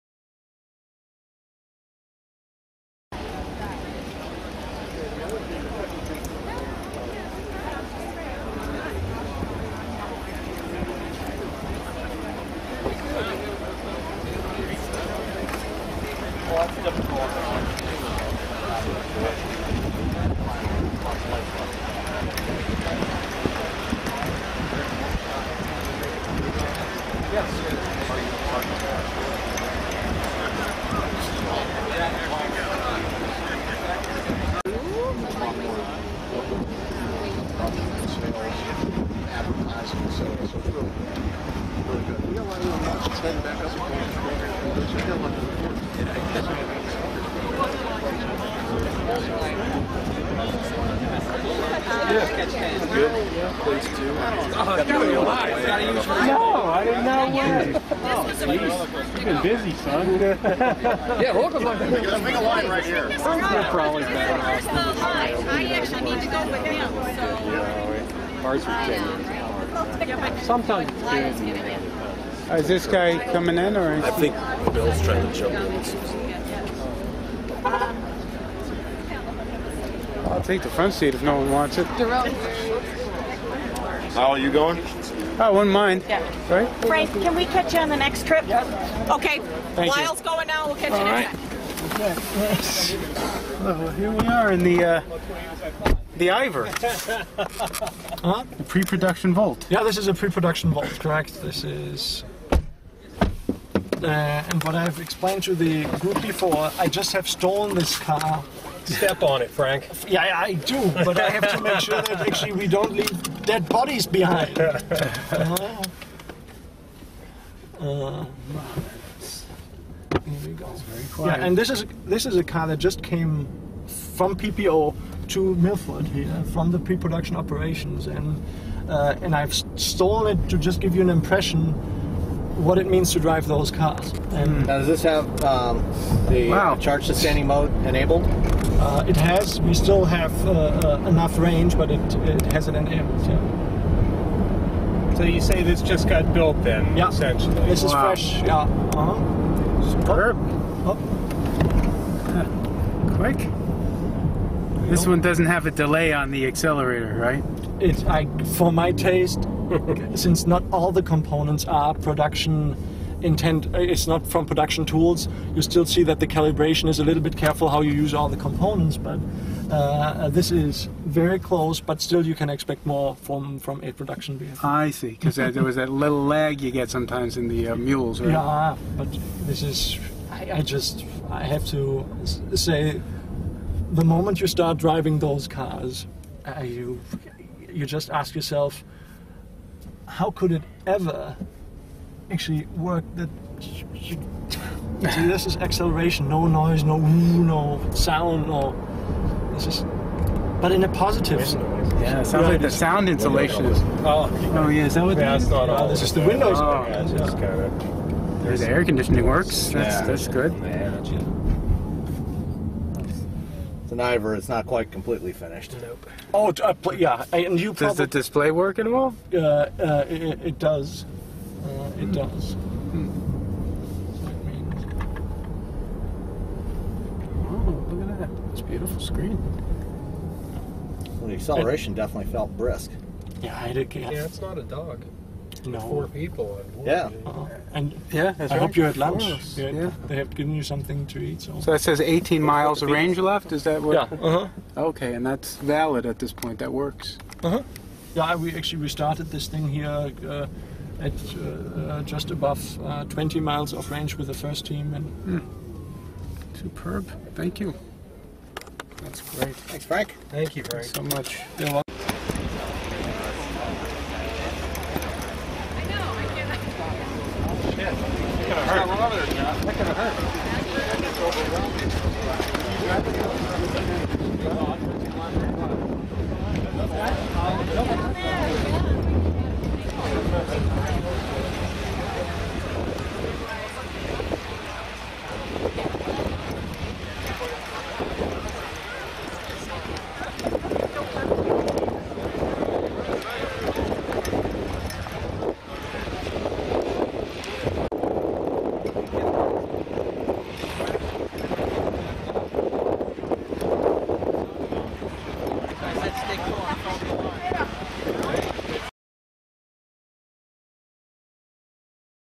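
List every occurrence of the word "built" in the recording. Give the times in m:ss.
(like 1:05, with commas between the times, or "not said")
2:26.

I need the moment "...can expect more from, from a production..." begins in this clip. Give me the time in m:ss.
2:52.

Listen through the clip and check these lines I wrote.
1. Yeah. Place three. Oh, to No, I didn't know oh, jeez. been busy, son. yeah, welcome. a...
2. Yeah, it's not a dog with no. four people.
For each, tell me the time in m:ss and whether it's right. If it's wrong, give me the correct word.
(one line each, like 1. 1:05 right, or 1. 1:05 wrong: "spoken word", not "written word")
1. 0:53 wrong: "two", not "three"
2. 3:53 right.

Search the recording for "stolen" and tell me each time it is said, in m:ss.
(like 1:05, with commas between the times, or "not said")
1:47, 2:09.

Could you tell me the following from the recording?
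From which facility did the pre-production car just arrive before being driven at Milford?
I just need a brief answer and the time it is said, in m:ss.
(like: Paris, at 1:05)
PPO, at 2:04.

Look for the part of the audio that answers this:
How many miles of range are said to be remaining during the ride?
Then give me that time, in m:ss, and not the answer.
4:02.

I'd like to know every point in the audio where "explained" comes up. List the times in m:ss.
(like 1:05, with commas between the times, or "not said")
1:44.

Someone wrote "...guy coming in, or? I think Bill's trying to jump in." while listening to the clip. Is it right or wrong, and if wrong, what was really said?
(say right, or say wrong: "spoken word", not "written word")
right.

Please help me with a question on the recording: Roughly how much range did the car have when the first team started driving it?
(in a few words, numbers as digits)
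Just above 20 miles.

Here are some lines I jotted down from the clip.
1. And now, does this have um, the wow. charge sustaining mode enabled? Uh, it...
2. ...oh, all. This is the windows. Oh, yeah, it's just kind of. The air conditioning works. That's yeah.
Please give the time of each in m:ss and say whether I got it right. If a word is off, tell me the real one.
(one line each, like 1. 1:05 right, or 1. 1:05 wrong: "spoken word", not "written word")
1. 2:14 right
2. 3:25 right.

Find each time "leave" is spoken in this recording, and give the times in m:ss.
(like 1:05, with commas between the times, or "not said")
1:52.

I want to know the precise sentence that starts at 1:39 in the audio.
Yeah, this is a pre-production Volt, correct?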